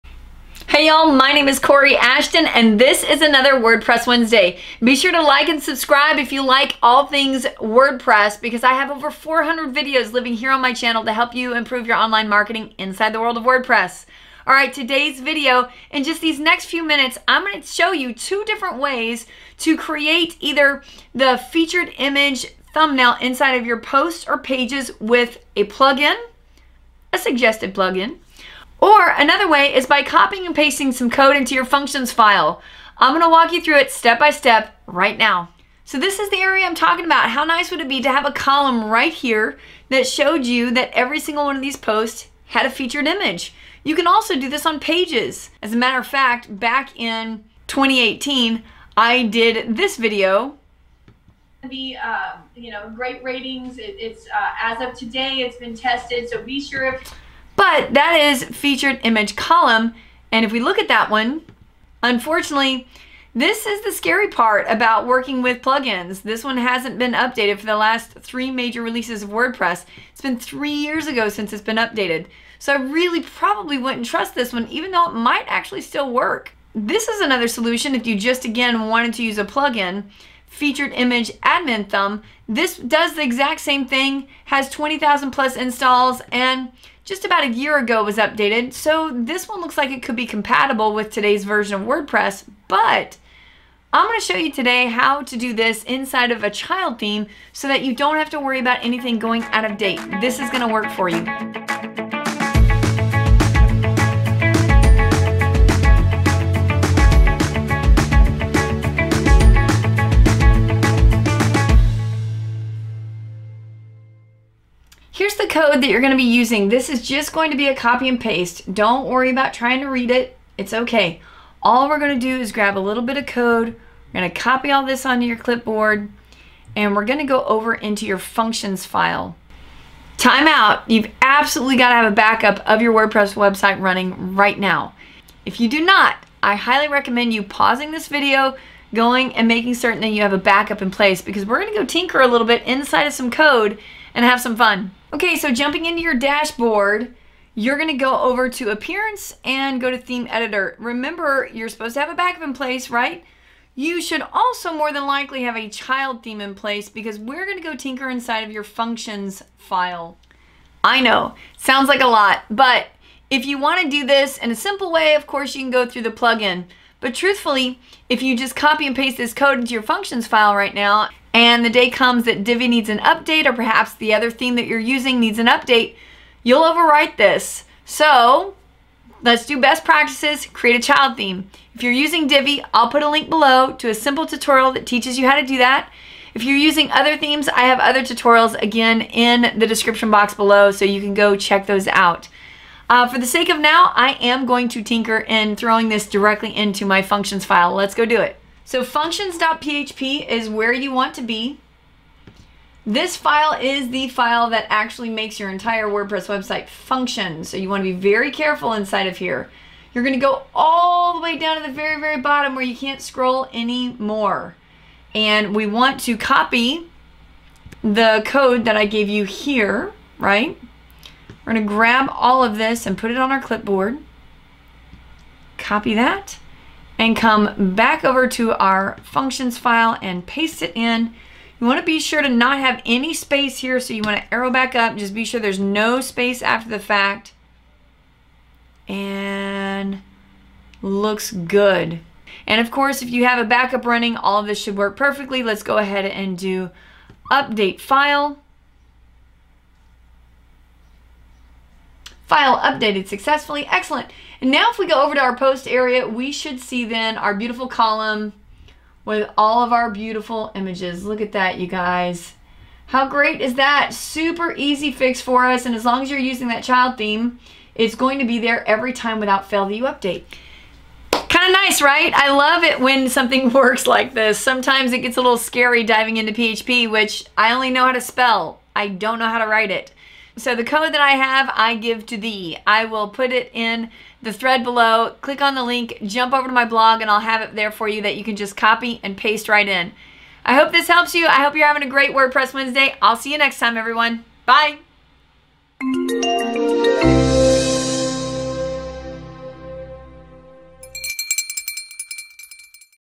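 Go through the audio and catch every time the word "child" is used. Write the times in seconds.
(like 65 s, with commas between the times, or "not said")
96 s, 155 s, 180 s, 266 s.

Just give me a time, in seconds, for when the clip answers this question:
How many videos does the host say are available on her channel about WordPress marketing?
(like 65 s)
8 s.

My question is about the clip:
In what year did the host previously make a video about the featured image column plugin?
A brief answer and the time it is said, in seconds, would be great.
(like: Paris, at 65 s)
2018, at 47 s.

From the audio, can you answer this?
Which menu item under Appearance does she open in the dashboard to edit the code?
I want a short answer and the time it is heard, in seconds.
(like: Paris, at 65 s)
Theme Editor, at 149 s.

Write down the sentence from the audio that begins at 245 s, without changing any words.
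Let's go ahead and do update file.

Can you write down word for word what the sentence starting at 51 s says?
The uh, you know great ratings.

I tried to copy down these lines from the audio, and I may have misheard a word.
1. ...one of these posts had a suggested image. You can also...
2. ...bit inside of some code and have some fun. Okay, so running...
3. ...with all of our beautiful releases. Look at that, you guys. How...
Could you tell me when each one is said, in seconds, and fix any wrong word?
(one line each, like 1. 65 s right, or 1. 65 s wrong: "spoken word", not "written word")
1. 41 s wrong: "featured", not "suggested"
2. 142 s wrong: "jumping", not "running"
3. 259 s wrong: "images", not "releases".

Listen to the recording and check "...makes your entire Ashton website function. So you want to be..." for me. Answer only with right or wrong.
wrong.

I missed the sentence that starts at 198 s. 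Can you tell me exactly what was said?
So functions.php is where you want to be.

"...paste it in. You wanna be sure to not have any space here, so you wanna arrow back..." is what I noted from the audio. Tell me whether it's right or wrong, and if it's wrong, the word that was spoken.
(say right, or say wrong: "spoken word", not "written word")
right.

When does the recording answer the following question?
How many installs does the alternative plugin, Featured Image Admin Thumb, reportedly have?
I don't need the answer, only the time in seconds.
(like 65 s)
84 s.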